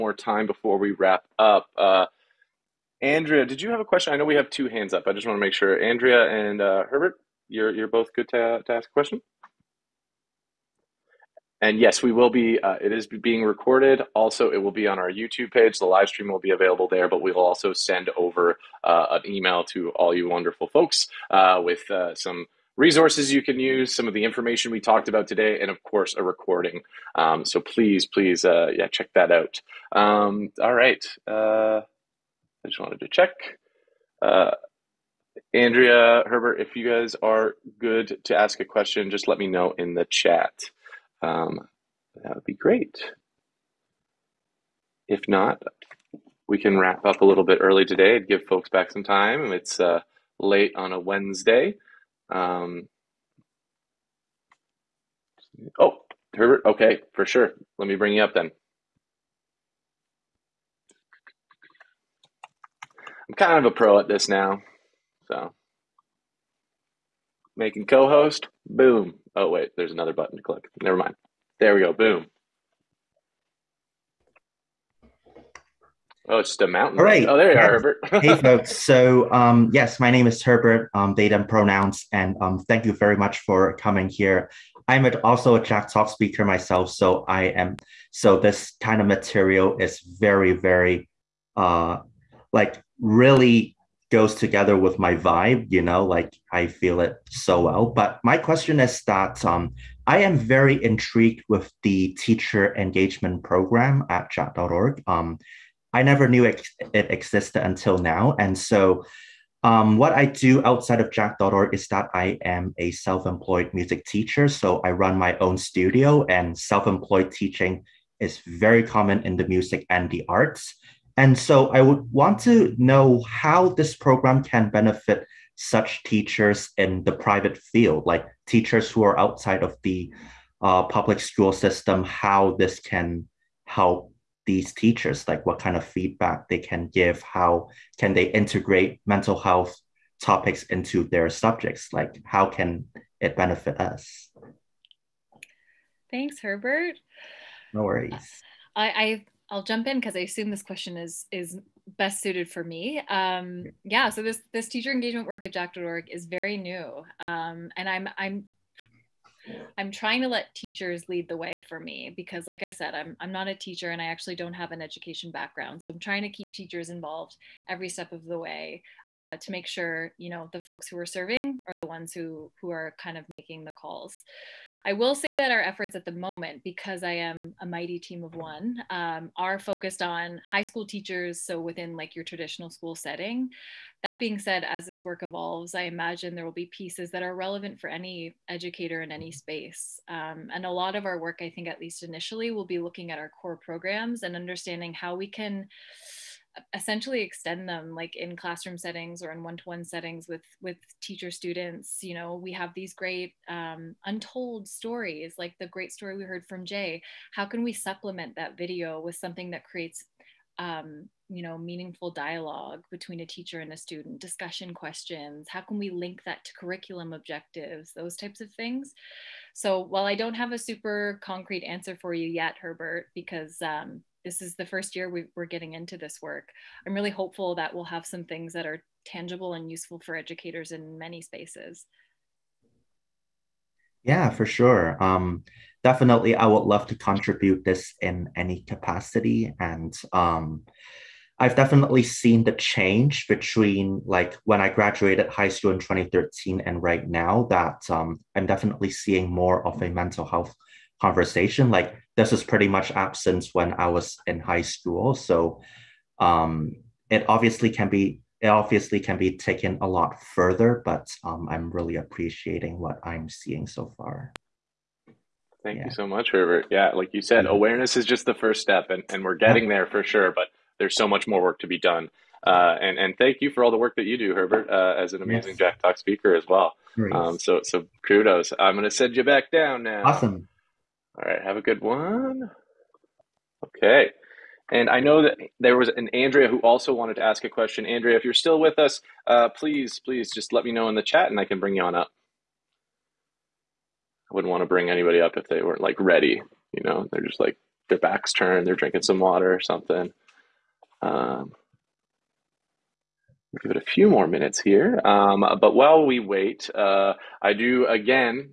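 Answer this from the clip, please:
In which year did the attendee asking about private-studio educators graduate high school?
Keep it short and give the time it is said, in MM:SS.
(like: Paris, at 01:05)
2013, at 04:05.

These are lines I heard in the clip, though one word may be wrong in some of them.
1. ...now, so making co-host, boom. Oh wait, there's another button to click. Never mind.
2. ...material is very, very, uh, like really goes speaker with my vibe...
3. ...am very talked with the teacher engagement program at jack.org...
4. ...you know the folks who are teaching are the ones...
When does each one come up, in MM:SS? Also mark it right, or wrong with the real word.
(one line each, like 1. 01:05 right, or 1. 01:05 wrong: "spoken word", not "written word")
1. 01:04 right
2. 01:29 wrong: "together", not "speaker"
3. 01:40 wrong: "intrigued", not "talked"
4. 02:50 wrong: "serving", not "teaching".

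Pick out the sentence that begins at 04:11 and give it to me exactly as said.
Like this is pretty much absent when I was in high school.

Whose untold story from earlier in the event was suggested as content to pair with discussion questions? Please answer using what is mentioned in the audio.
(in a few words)
Jay.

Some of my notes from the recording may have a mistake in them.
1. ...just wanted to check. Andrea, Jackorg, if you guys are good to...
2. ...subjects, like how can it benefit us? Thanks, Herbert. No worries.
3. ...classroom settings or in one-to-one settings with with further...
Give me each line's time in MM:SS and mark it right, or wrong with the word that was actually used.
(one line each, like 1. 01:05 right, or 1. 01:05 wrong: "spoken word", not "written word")
1. 00:32 wrong: "Herbert", not "Jackorg"
2. 02:21 right
3. 03:18 wrong: "teacher", not "further".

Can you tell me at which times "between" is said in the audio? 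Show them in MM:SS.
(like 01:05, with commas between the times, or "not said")
03:32, 04:03.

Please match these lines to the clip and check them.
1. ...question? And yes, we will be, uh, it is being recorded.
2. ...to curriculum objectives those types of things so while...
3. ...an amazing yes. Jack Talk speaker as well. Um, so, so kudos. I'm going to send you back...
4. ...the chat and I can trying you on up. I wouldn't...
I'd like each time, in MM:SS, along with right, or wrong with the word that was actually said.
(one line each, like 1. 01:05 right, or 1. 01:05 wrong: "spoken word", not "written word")
1. 00:08 right
2. 03:36 right
3. 04:35 right
4. 04:50 wrong: "bring", not "trying".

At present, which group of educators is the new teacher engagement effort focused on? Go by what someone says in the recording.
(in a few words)
High school teachers.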